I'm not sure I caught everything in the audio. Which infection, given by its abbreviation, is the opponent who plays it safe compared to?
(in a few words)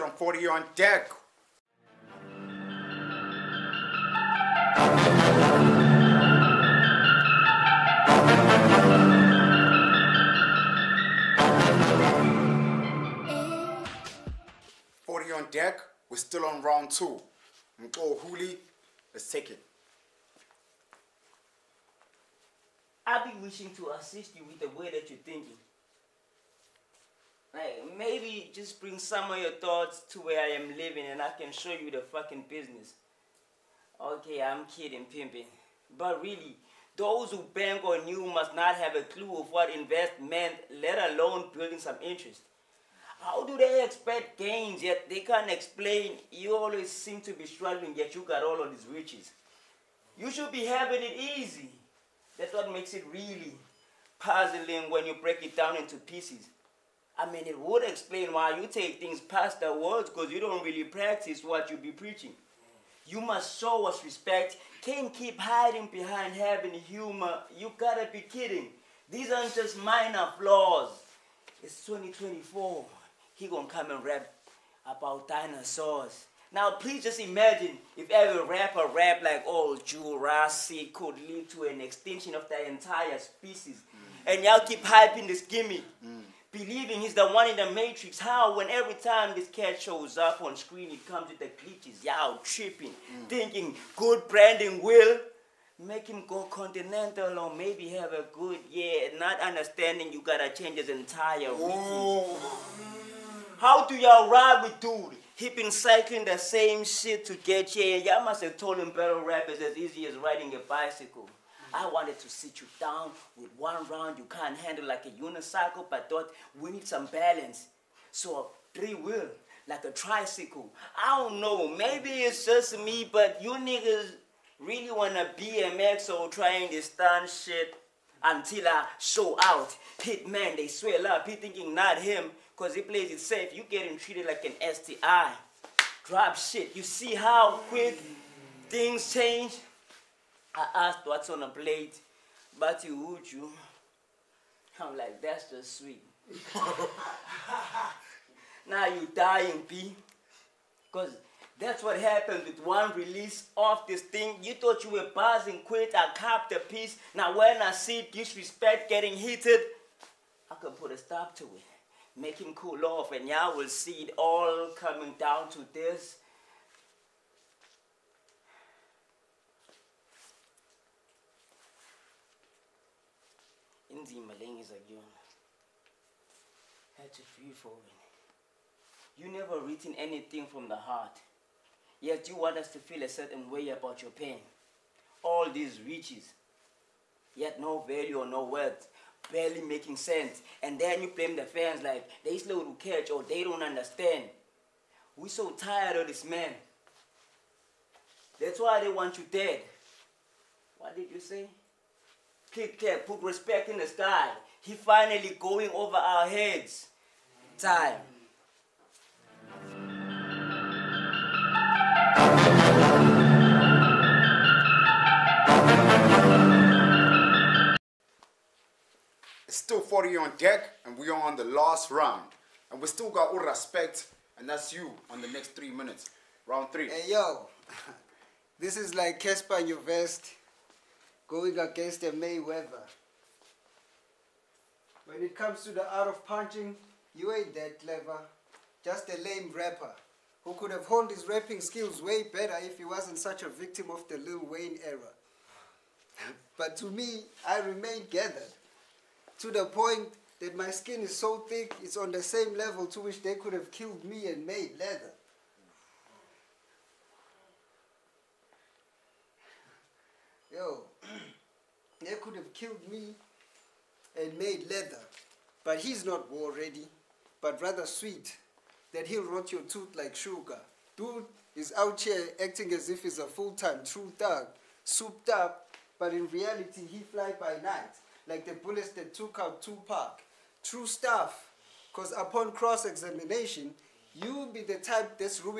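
STI.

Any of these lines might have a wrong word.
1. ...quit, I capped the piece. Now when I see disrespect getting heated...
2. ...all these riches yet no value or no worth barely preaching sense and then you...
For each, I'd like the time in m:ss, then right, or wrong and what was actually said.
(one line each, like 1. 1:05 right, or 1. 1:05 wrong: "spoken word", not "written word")
1. 2:35 right
2. 3:05 wrong: "making", not "preaching".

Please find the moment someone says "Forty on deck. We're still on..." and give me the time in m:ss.
0:15.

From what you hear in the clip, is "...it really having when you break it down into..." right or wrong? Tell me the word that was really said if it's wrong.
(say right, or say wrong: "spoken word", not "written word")
wrong: "puzzling", not "having".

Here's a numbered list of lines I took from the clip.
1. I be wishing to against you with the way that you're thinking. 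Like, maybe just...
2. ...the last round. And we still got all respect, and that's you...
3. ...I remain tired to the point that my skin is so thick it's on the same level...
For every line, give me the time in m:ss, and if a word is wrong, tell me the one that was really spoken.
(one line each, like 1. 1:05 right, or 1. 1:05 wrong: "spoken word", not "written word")
1. 0:23 wrong: "assist", not "against"
2. 3:41 right
3. 4:07 wrong: "gathered", not "tired".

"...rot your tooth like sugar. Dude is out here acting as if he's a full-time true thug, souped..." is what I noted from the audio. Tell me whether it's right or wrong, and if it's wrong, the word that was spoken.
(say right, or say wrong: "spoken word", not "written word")
right.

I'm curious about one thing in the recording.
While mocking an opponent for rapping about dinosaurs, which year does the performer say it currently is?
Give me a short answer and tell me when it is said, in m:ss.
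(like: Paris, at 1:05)
2024, at 1:11.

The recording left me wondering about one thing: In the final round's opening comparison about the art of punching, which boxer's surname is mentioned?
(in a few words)
Mayweather.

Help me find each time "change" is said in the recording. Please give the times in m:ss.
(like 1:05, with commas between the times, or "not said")
1:40, 2:19.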